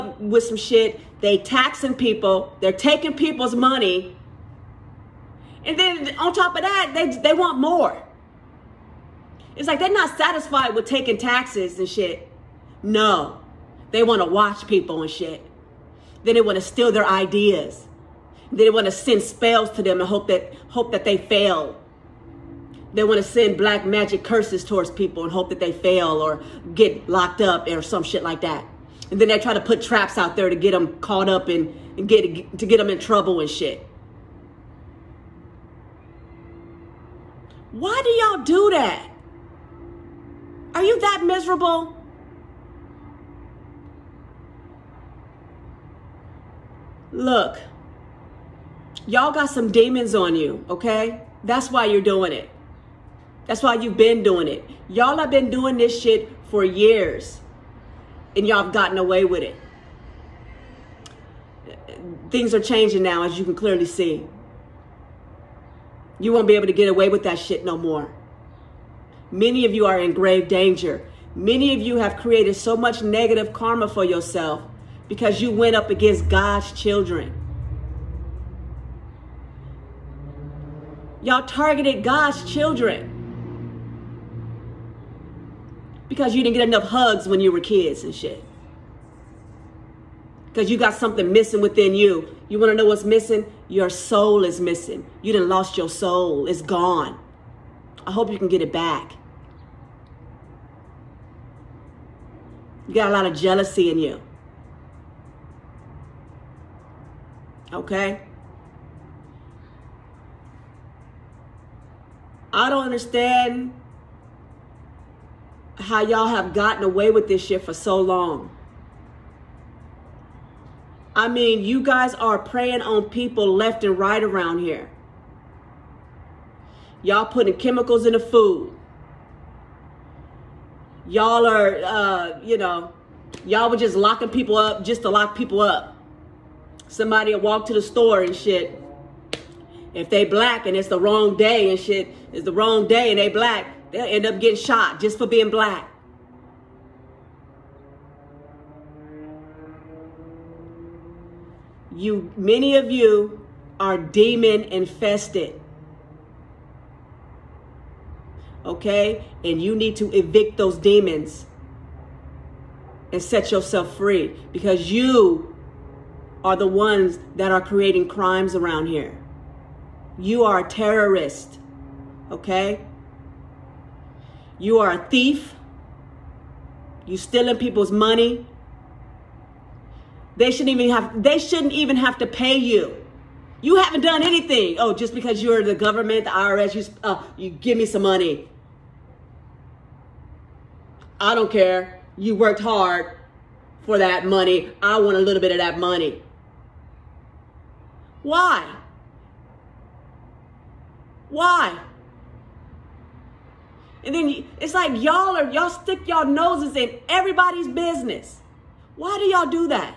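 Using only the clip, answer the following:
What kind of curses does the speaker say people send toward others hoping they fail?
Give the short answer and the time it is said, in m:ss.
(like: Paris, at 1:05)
black magic, at 0:23.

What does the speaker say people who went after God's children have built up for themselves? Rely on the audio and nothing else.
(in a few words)
negative karma.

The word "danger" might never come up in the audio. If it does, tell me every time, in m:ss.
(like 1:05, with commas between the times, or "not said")
1:10.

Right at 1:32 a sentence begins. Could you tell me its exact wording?
You want to know what's missing?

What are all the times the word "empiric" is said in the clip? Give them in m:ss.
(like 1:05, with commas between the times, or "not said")
not said.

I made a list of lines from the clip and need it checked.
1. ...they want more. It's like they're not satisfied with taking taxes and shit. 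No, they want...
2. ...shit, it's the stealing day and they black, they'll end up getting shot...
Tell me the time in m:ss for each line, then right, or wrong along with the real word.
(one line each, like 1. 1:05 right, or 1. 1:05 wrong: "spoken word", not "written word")
1. 0:07 right
2. 2:21 wrong: "wrong", not "stealing".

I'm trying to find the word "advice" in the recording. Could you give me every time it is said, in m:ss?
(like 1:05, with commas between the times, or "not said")
not said.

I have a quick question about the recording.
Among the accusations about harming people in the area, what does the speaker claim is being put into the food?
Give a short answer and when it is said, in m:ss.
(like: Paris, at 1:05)
chemicals, at 2:07.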